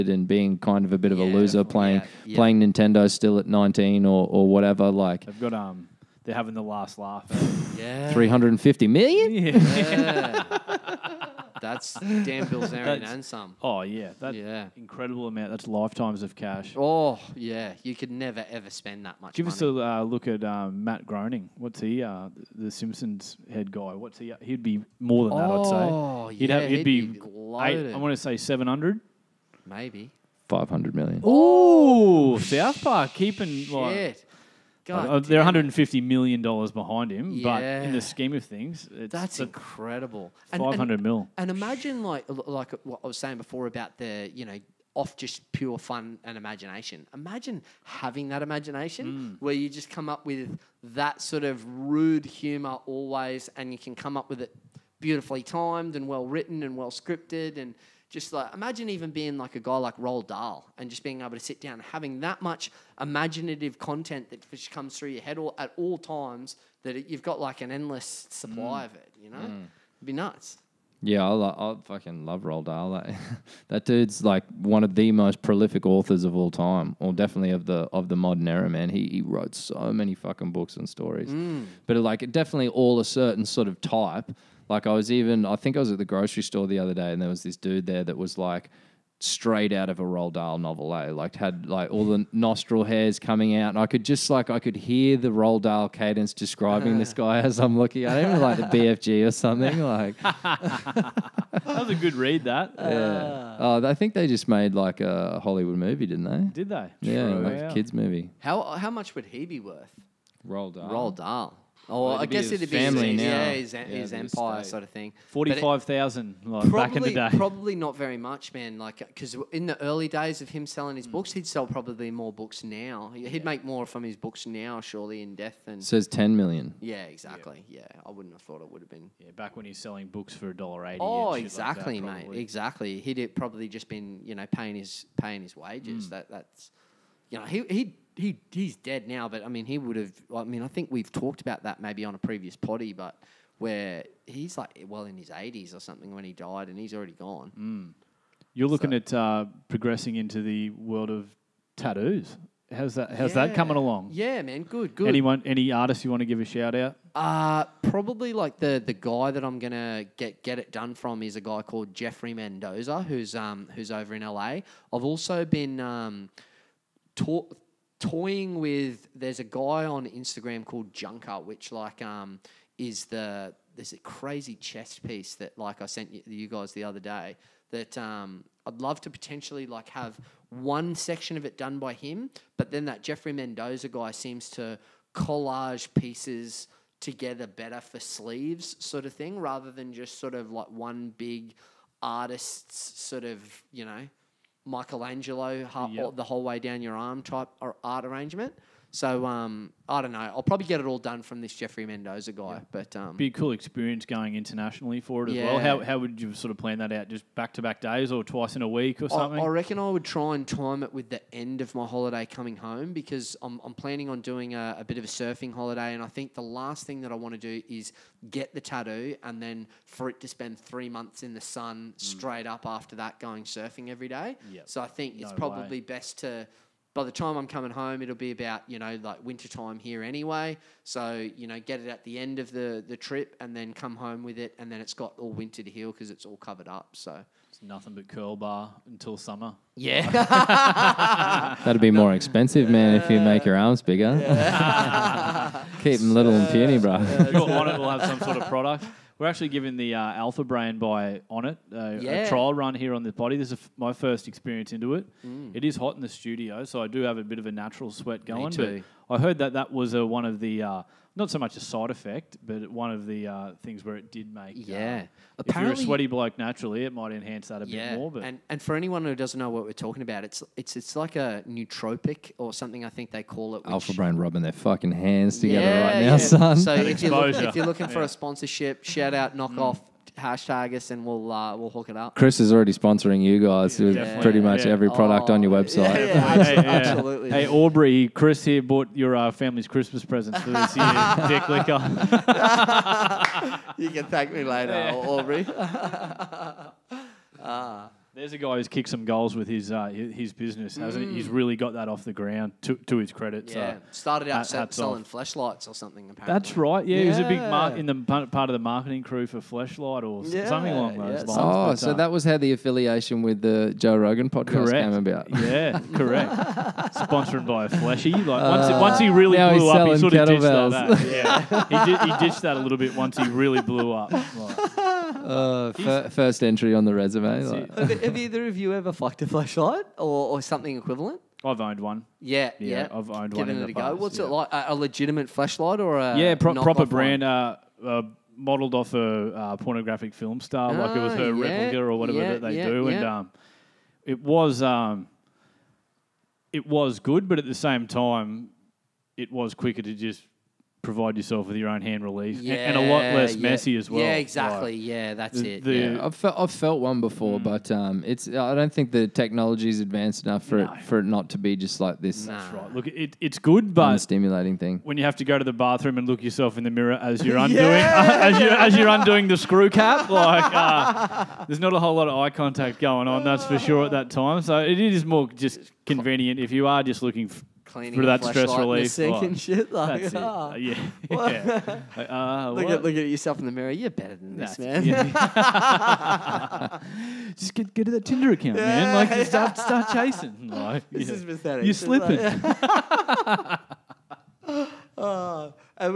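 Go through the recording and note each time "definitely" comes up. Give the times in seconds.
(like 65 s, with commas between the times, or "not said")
77 s, 82 s, 283 s.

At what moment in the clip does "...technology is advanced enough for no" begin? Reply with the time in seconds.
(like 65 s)
359 s.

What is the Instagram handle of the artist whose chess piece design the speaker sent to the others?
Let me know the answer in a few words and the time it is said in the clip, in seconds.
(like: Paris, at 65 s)
Junker, at 170 s.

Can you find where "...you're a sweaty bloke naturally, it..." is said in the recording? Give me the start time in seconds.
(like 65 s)
265 s.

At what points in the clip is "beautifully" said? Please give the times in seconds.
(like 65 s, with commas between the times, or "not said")
54 s.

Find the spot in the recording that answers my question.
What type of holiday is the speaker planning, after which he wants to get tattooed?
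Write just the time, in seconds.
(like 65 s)
215 s.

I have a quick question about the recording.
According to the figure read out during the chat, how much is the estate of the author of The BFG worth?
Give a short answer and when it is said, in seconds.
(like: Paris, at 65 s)
10 million, at 126 s.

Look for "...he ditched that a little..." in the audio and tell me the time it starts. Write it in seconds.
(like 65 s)
322 s.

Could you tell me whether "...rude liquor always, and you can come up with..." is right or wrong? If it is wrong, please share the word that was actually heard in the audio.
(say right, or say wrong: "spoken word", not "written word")
wrong: "humor", not "liquor".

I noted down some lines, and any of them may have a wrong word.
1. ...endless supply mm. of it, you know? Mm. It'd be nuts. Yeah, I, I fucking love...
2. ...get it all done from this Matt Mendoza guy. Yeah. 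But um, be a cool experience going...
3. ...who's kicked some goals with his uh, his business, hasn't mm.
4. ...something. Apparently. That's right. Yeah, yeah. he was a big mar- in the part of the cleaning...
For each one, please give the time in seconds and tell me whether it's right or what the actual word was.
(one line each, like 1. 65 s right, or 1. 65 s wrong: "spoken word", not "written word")
1. 67 s right
2. 200 s wrong: "Jeffrey", not "Matt"
3. 298 s right
4. 305 s wrong: "marketing", not "cleaning".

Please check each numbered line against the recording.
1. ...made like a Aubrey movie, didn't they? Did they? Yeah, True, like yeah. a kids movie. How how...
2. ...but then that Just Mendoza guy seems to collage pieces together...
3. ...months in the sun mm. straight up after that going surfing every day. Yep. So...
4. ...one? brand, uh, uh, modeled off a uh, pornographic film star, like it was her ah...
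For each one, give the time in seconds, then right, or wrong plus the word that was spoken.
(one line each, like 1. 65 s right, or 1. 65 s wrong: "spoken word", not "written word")
1. 104 s wrong: "Hollywood", not "Aubrey"
2. 182 s wrong: "Jeffrey", not "Just"
3. 220 s right
4. 336 s right.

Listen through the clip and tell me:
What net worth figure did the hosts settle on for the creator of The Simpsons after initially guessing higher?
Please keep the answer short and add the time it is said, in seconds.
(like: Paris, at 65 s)
500 million, at 30 s.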